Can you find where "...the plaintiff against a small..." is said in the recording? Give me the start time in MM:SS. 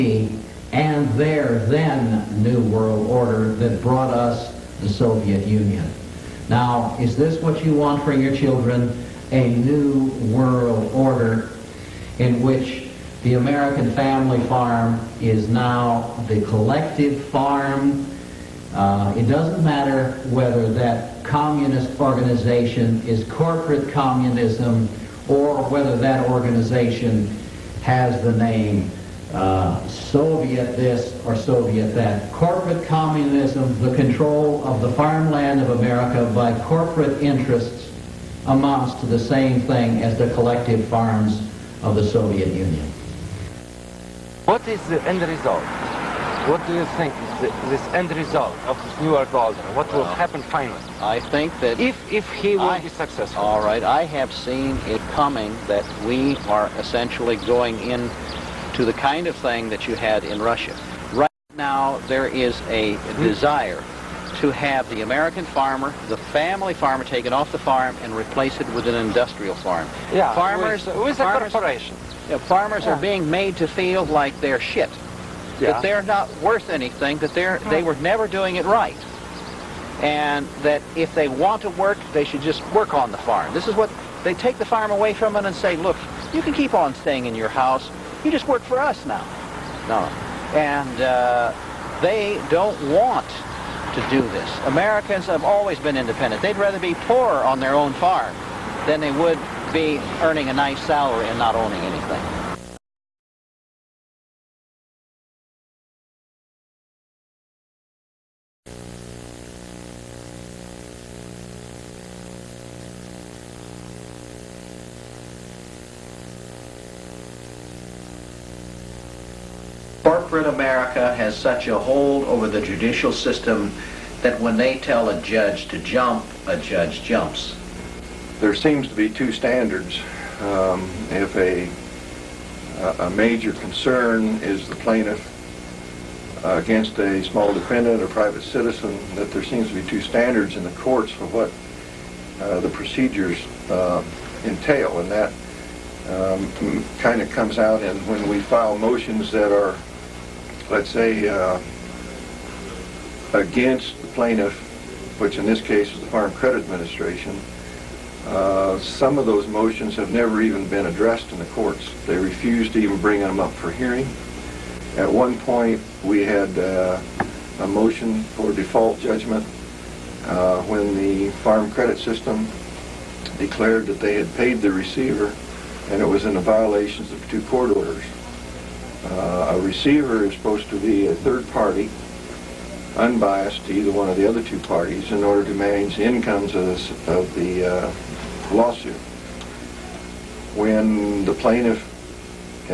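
02:14.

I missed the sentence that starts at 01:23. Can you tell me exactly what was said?
This is what they take the farm away from them and say, look, you can keep on staying in your house.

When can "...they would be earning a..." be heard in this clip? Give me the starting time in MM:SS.
01:39.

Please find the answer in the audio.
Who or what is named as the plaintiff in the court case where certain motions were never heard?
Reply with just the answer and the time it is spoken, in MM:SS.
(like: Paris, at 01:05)
Farm Credit Administration, at 02:36.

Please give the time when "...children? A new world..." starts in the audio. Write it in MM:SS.
00:08.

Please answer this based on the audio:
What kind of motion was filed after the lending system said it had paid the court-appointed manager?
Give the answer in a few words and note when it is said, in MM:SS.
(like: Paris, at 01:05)
default judgment, at 02:48.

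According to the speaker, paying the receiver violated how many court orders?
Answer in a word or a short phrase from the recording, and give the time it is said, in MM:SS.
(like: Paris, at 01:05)
2, at 02:57.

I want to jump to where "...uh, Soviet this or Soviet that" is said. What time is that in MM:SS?
00:29.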